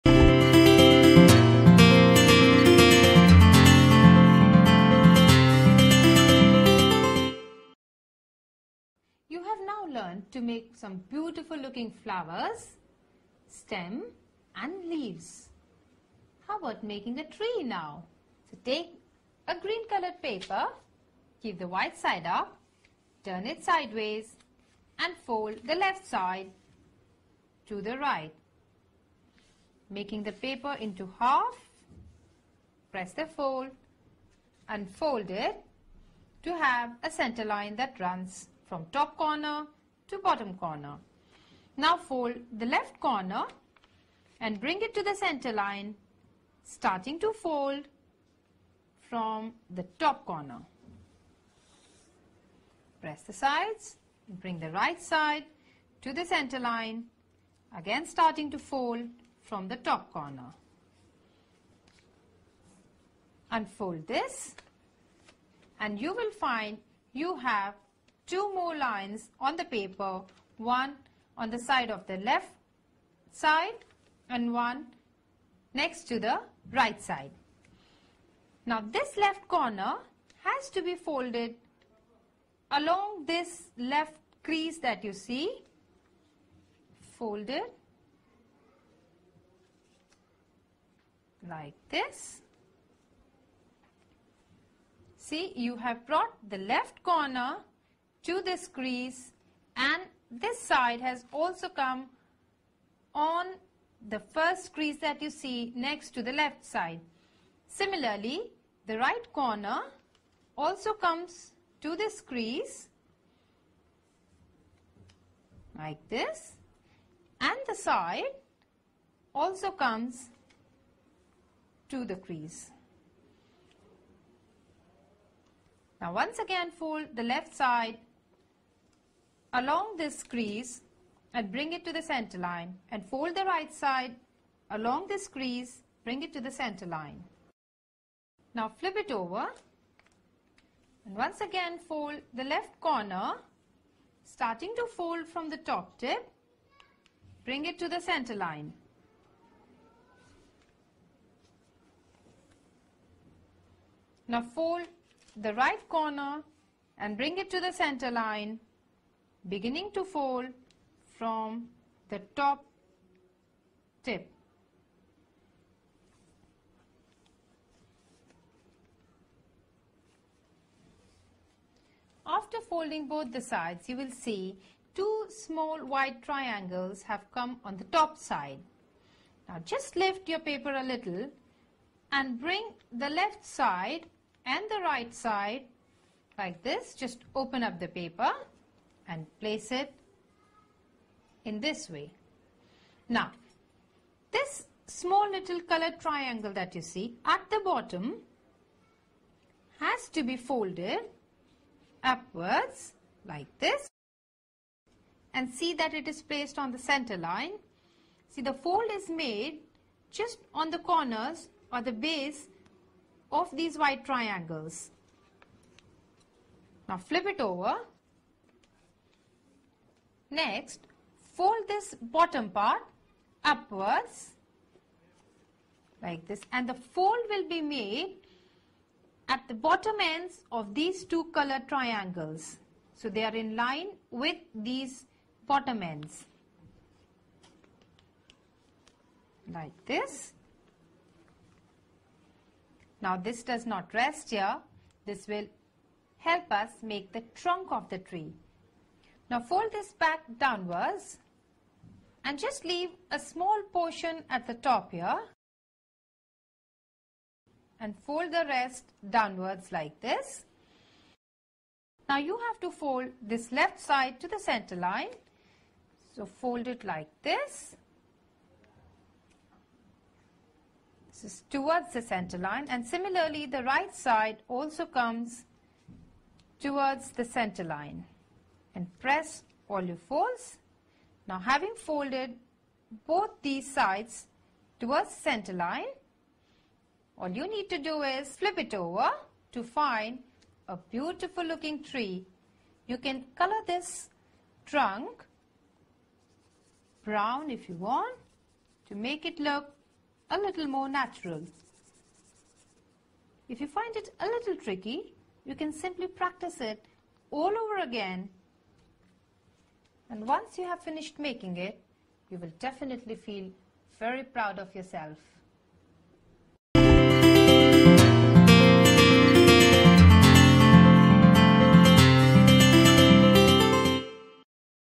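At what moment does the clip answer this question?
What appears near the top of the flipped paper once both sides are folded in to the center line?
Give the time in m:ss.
2:54.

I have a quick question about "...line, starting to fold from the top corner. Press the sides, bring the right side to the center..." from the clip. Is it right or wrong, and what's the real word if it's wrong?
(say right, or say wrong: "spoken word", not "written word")
right.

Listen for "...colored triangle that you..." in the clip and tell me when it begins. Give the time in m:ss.
3:15.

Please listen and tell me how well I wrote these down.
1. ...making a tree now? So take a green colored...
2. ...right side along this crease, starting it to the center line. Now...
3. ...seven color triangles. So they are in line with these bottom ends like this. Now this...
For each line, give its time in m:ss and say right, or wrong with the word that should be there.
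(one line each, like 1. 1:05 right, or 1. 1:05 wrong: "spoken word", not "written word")
1. 0:16 right
2. 2:13 wrong: "bring", not "starting"
3. 3:51 wrong: "two", not "seven".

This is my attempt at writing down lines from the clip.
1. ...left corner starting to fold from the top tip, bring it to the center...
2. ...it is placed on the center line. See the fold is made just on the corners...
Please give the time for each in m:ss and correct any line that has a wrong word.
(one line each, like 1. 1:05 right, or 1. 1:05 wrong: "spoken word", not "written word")
1. 2:22 right
2. 3:25 right.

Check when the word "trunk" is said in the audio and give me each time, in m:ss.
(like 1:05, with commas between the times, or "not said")
4:07, 4:54.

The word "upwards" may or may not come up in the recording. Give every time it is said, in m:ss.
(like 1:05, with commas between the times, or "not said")
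3:22, 3:43.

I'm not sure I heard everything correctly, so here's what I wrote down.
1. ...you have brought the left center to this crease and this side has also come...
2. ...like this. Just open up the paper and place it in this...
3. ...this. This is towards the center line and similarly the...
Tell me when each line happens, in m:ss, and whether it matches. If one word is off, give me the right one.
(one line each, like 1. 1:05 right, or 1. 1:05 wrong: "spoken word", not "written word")
1. 1:35 wrong: "corner", not "center"
2. 3:06 right
3. 4:27 right.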